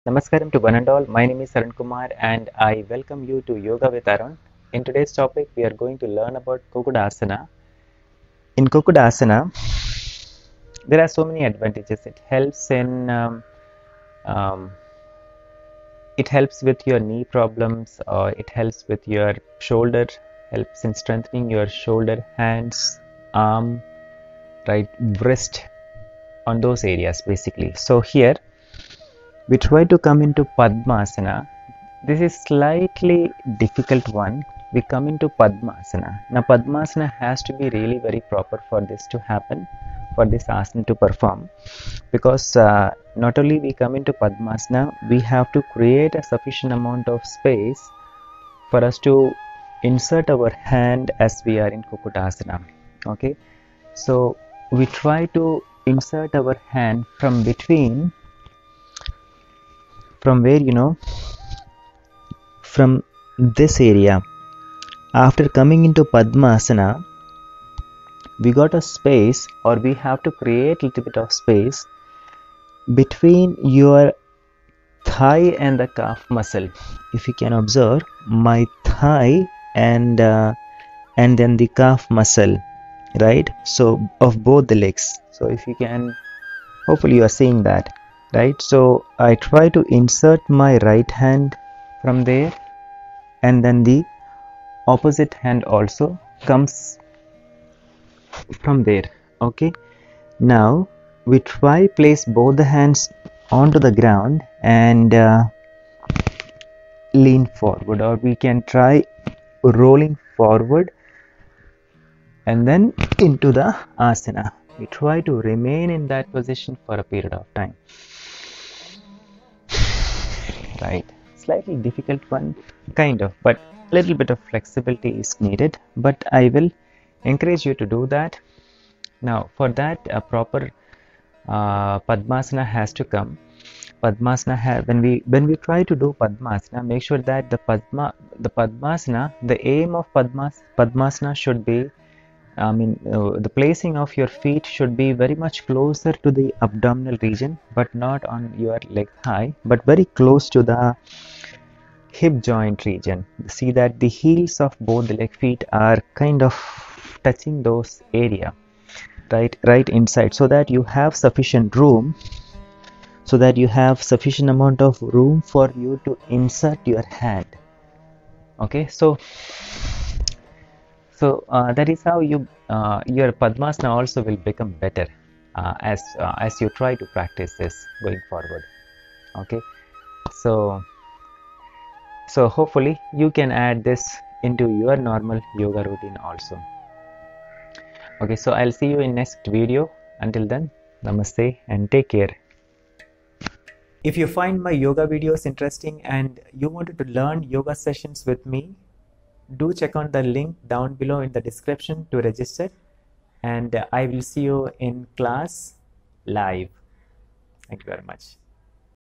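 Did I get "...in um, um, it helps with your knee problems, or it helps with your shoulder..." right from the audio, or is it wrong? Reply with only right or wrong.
right.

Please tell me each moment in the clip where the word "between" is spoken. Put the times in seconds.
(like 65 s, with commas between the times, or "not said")
57 s, 72 s.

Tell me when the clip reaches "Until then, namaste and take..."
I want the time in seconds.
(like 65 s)
190 s.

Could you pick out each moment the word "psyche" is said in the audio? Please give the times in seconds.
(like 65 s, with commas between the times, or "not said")
not said.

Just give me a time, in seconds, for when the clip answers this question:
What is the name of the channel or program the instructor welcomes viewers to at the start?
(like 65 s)
3 s.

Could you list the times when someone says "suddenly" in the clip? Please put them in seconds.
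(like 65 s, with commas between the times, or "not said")
not said.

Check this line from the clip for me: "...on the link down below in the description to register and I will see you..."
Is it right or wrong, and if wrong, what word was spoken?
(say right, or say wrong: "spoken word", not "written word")
right.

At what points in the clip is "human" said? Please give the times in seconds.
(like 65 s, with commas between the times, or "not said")
not said.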